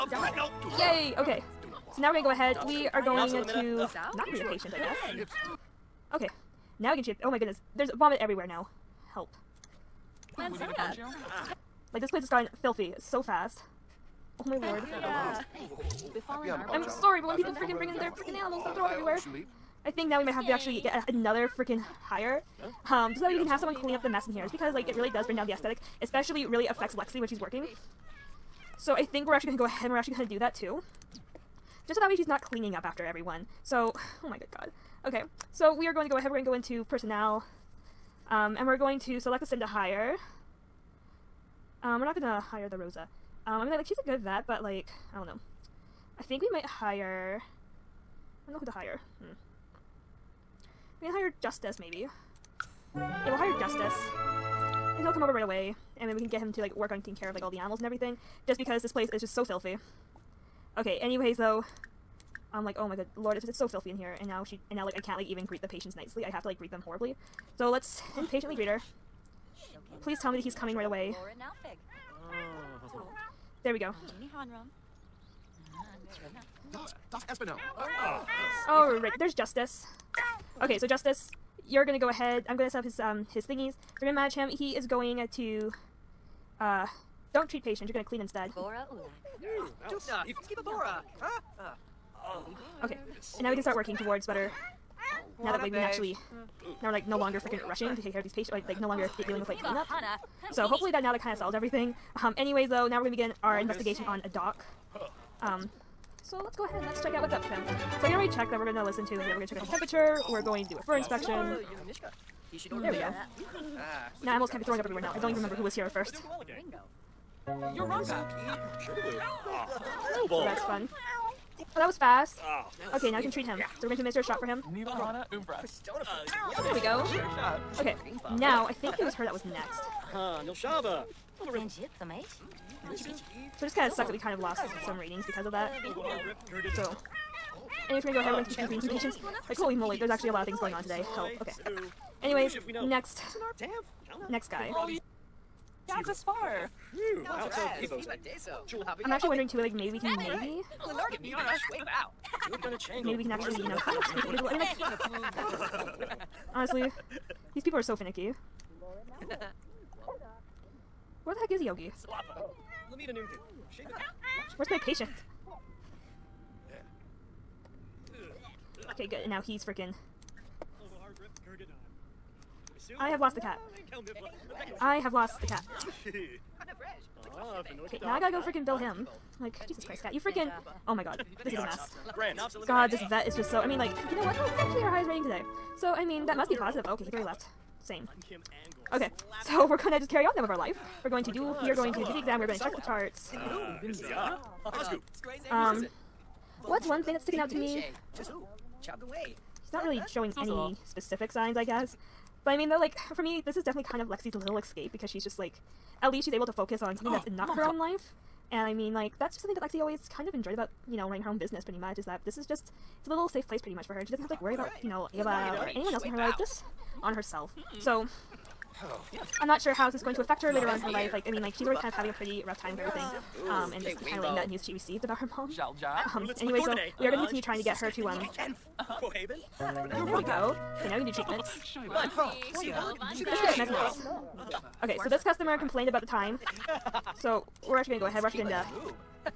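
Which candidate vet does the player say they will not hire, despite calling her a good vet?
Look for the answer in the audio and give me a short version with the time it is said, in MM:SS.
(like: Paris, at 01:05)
Rosa, at 00:41.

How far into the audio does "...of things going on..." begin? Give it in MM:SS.
02:20.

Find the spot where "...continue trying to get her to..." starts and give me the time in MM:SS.
03:47.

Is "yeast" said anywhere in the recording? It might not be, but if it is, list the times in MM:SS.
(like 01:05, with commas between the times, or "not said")
not said.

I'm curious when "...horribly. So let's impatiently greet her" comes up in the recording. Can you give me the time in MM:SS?
01:06.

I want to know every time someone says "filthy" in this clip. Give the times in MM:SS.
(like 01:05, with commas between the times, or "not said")
00:12, 00:59, 01:03.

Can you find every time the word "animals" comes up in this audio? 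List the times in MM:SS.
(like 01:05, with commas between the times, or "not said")
00:18, 00:57, 01:54.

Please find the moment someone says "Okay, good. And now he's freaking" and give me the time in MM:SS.
02:48.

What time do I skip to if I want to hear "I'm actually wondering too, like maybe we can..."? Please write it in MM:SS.
02:29.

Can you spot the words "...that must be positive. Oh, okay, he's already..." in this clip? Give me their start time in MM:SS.
03:06.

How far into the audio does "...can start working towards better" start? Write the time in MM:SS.
01:33.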